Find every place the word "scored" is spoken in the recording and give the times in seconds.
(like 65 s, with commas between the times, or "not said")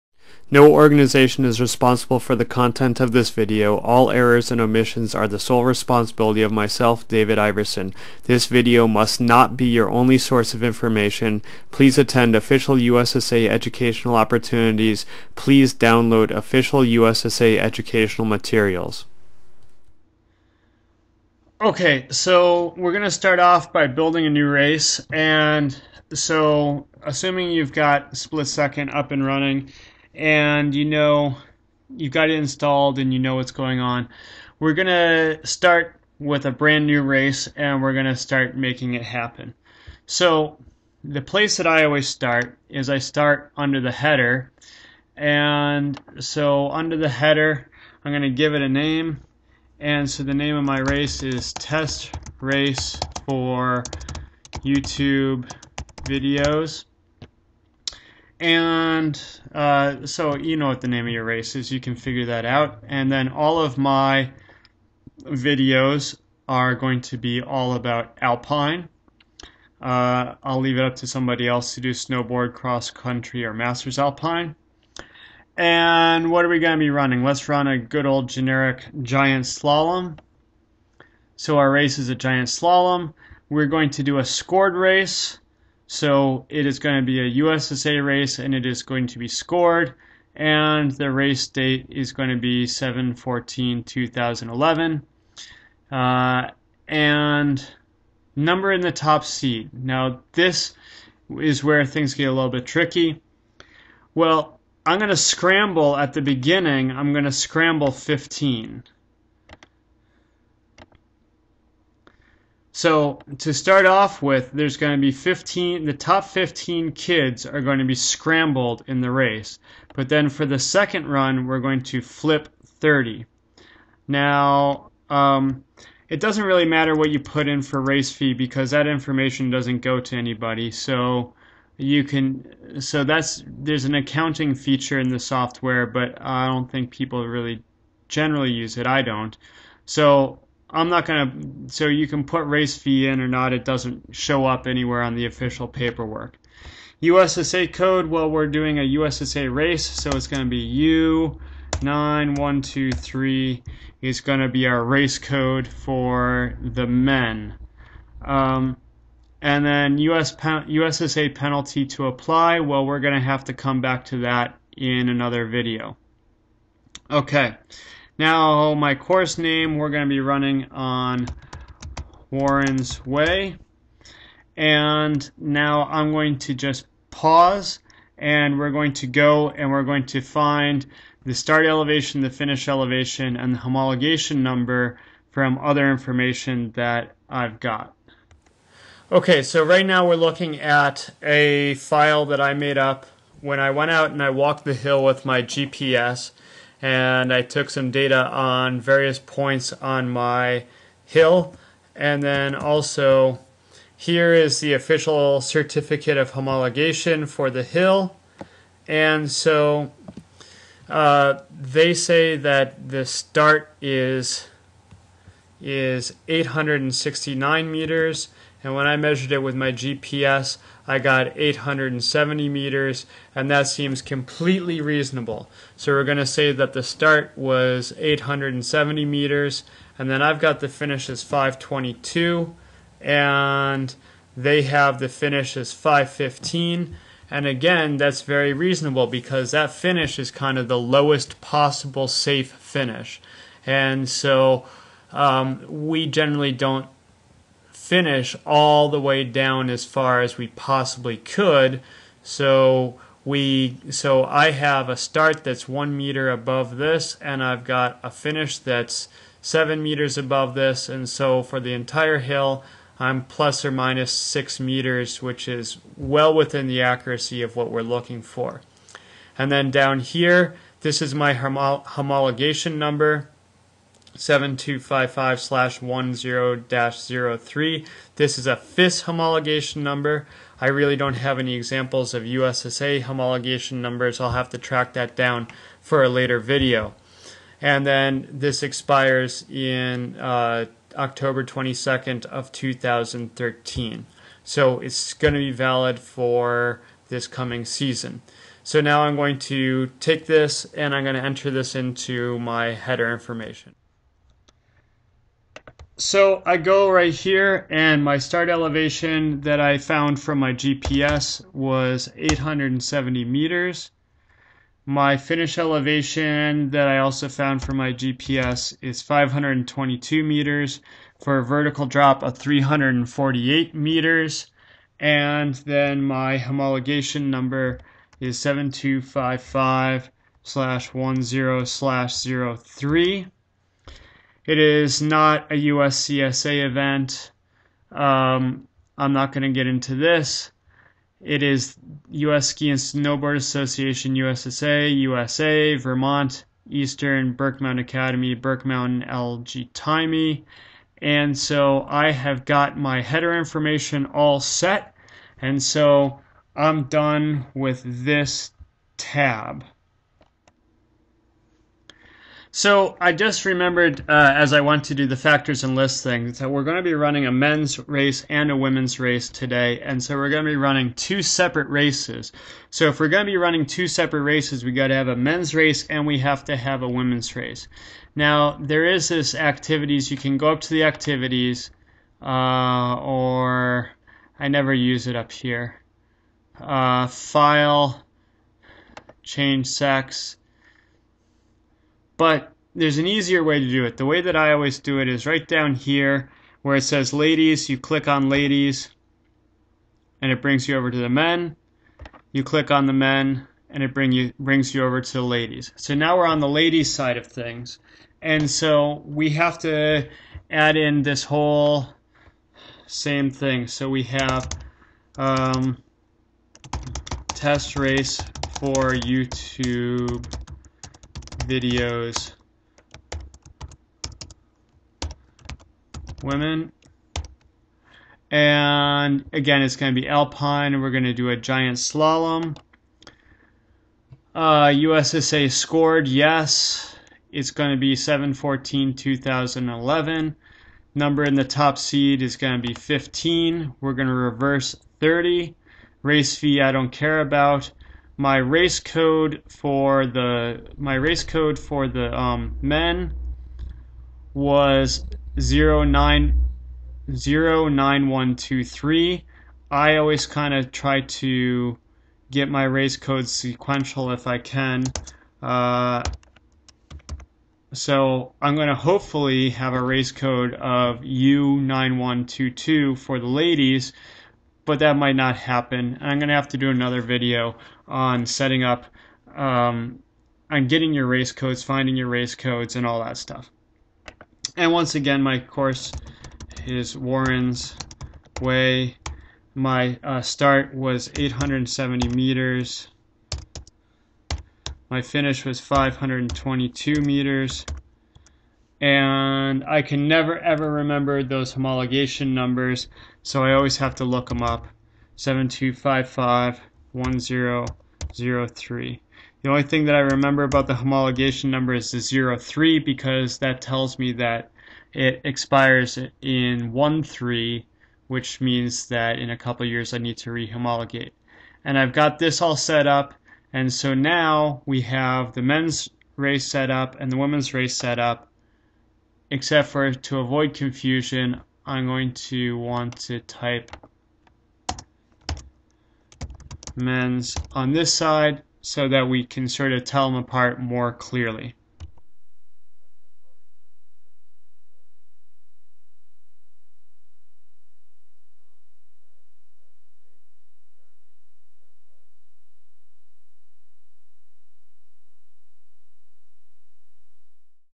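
84 s, 89 s, 435 s.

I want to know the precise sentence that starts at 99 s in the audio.
Now, this is where things get a little bit tricky.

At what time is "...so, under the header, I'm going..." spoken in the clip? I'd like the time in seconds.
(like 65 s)
46 s.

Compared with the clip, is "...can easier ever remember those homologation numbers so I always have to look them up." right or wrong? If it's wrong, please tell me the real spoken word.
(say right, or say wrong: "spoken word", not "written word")
wrong: "never", not "easier".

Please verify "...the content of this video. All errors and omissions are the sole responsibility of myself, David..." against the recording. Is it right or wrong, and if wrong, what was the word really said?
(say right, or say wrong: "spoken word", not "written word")
right.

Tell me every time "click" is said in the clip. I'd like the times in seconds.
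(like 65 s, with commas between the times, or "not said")
397 s, 402 s.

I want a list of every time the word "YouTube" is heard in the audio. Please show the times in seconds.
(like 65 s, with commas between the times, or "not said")
54 s, 418 s.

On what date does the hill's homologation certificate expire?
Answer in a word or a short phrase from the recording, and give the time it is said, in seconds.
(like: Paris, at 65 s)
October 22, 2013, at 290 s.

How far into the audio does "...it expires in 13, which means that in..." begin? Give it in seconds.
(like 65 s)
514 s.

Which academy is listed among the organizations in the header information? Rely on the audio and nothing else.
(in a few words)
Burke Academy.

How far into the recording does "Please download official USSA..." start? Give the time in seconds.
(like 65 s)
15 s.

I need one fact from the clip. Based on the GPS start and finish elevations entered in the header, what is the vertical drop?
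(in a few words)
348 meters.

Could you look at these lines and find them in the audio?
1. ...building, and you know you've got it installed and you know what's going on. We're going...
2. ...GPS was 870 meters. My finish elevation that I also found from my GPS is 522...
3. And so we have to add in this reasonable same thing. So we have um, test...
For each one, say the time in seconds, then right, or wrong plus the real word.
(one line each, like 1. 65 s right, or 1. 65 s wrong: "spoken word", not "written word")
1. 29 s wrong: "running", not "building"
2. 310 s right
3. 408 s wrong: "whole", not "reasonable".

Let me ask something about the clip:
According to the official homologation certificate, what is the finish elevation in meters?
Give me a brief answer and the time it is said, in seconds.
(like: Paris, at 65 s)
515, at 235 s.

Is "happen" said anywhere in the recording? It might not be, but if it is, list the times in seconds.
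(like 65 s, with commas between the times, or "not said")
39 s, 475 s.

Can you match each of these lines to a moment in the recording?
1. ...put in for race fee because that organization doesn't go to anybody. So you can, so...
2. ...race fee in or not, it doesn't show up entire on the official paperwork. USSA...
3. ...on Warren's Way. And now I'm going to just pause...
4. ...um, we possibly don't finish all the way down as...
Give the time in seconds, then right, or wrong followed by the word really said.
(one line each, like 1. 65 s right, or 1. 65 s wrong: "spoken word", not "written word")
1. 127 s wrong: "information", not "organization"
2. 142 s wrong: "anywhere", not "entire"
3. 170 s right
4. 245 s wrong: "generally", not "possibly".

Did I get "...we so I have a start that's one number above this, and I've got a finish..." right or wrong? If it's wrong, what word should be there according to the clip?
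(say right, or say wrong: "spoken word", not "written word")
wrong: "meter", not "number".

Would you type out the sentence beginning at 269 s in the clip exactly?
And then down here, this is my homo homologation number.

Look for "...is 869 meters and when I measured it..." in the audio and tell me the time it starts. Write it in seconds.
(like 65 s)
215 s.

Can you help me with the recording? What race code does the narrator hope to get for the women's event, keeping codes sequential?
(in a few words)
U9122.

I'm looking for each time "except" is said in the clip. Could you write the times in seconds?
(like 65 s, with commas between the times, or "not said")
529 s.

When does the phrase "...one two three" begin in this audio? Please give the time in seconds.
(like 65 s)
458 s.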